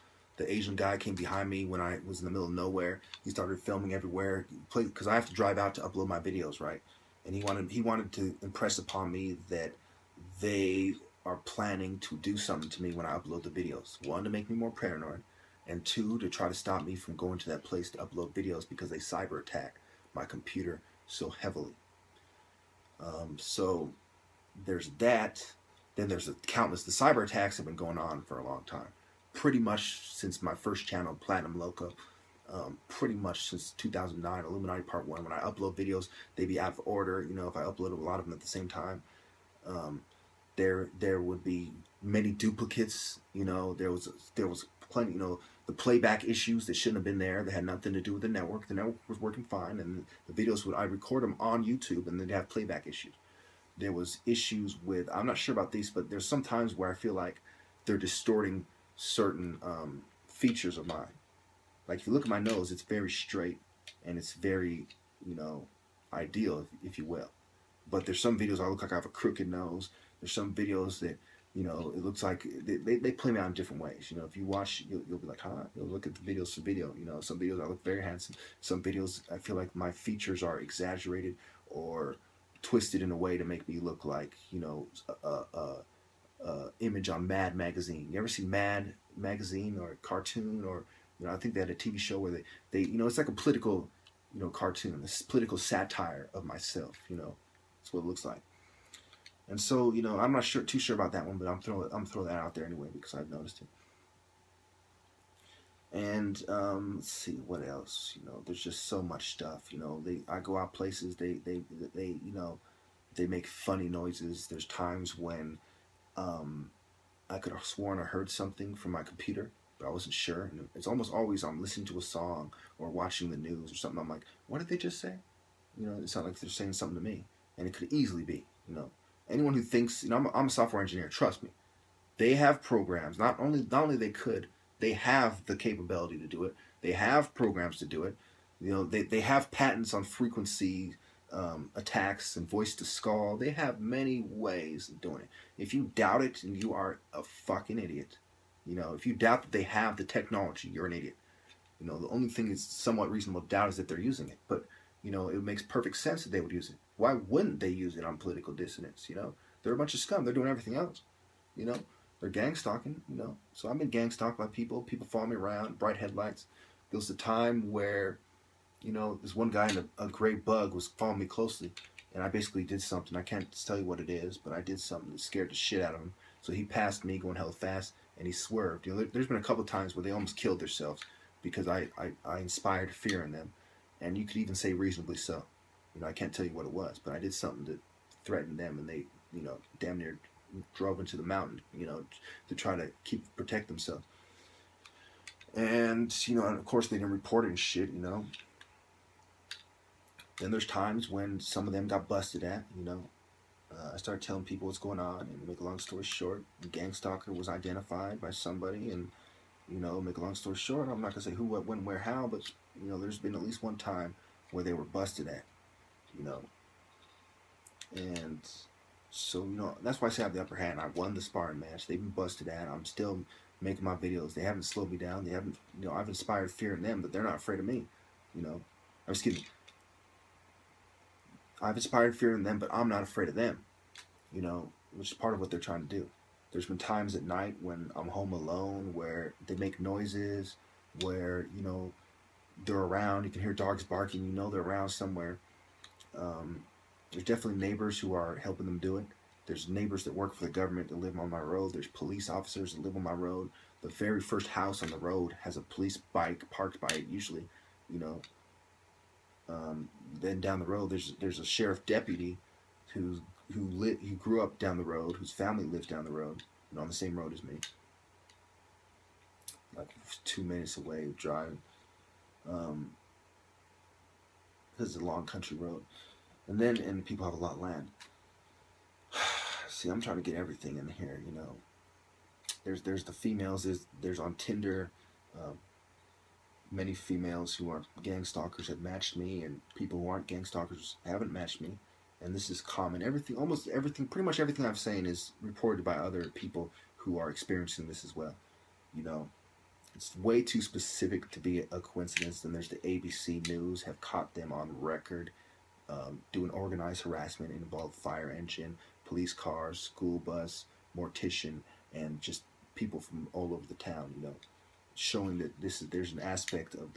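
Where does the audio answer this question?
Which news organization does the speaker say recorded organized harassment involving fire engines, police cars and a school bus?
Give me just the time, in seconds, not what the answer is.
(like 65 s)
302 s.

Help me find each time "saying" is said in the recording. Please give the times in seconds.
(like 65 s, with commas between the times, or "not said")
126 s, 294 s.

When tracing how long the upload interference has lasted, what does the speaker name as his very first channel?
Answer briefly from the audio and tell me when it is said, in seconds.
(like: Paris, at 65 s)
Platinum Loco, at 31 s.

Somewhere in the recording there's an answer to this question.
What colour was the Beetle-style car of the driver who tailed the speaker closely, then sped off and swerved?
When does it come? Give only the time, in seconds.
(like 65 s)
170 s.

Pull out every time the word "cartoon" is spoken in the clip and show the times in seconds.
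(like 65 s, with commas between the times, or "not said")
90 s, 94 s.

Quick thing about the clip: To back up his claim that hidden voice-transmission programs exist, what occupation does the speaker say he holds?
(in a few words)
Software engineer.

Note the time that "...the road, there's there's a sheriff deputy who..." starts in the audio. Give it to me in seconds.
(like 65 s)
260 s.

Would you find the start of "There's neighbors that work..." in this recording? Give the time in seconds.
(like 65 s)
249 s.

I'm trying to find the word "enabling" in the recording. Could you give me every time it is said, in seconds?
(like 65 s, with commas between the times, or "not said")
not said.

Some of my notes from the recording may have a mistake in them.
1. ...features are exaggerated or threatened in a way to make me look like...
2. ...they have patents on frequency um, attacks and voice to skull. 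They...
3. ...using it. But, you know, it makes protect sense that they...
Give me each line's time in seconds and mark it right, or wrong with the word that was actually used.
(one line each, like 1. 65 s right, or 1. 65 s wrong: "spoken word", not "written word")
1. 79 s wrong: "twisted", not "threatened"
2. 139 s right
3. 153 s wrong: "perfect", not "protect".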